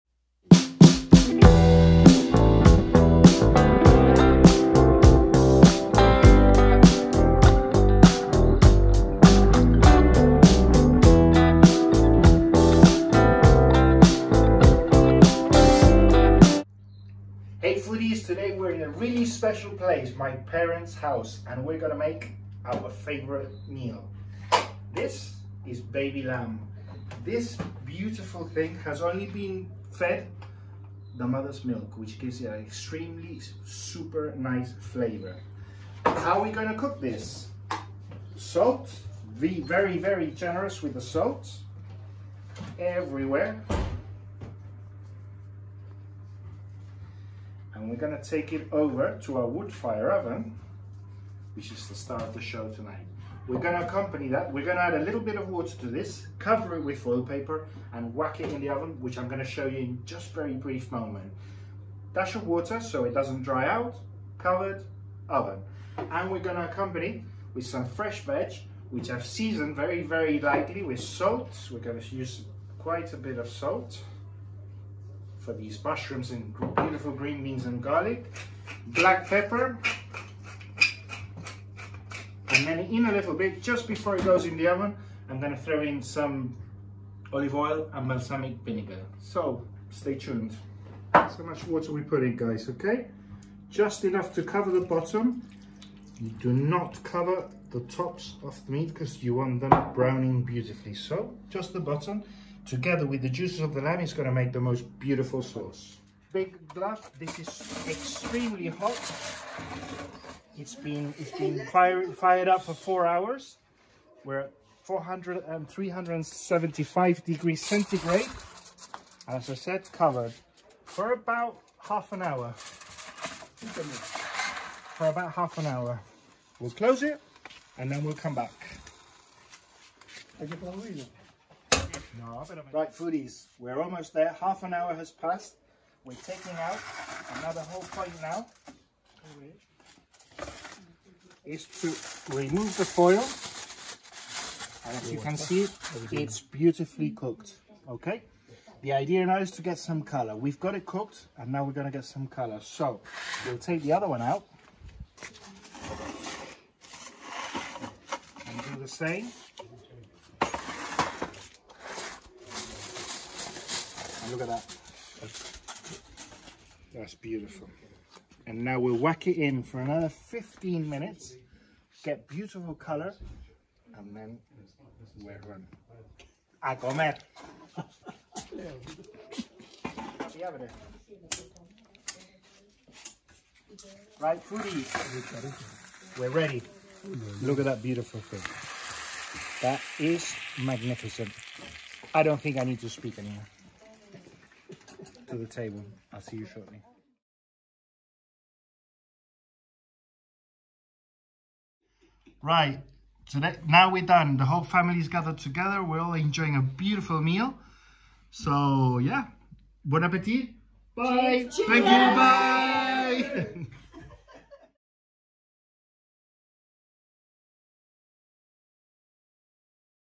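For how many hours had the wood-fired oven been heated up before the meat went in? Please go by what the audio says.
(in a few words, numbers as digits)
4 hours.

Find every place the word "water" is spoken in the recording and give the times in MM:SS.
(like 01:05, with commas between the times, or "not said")
00:55, 01:02, 01:31.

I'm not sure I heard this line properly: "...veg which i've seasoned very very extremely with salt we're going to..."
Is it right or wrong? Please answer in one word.
wrong.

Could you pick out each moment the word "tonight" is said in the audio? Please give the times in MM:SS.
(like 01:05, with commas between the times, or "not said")
00:52.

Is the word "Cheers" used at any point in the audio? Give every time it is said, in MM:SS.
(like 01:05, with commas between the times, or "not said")
03:31.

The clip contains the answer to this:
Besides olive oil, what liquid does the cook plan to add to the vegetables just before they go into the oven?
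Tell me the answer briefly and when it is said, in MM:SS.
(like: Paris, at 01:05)
balsamic vinegar, at 01:28.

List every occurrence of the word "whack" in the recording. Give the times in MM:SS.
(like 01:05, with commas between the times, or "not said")
00:58, 02:48.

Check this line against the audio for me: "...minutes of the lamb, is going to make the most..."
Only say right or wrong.
wrong.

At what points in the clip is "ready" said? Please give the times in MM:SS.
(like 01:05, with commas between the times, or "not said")
03:06.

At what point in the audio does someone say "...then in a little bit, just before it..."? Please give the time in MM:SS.
01:22.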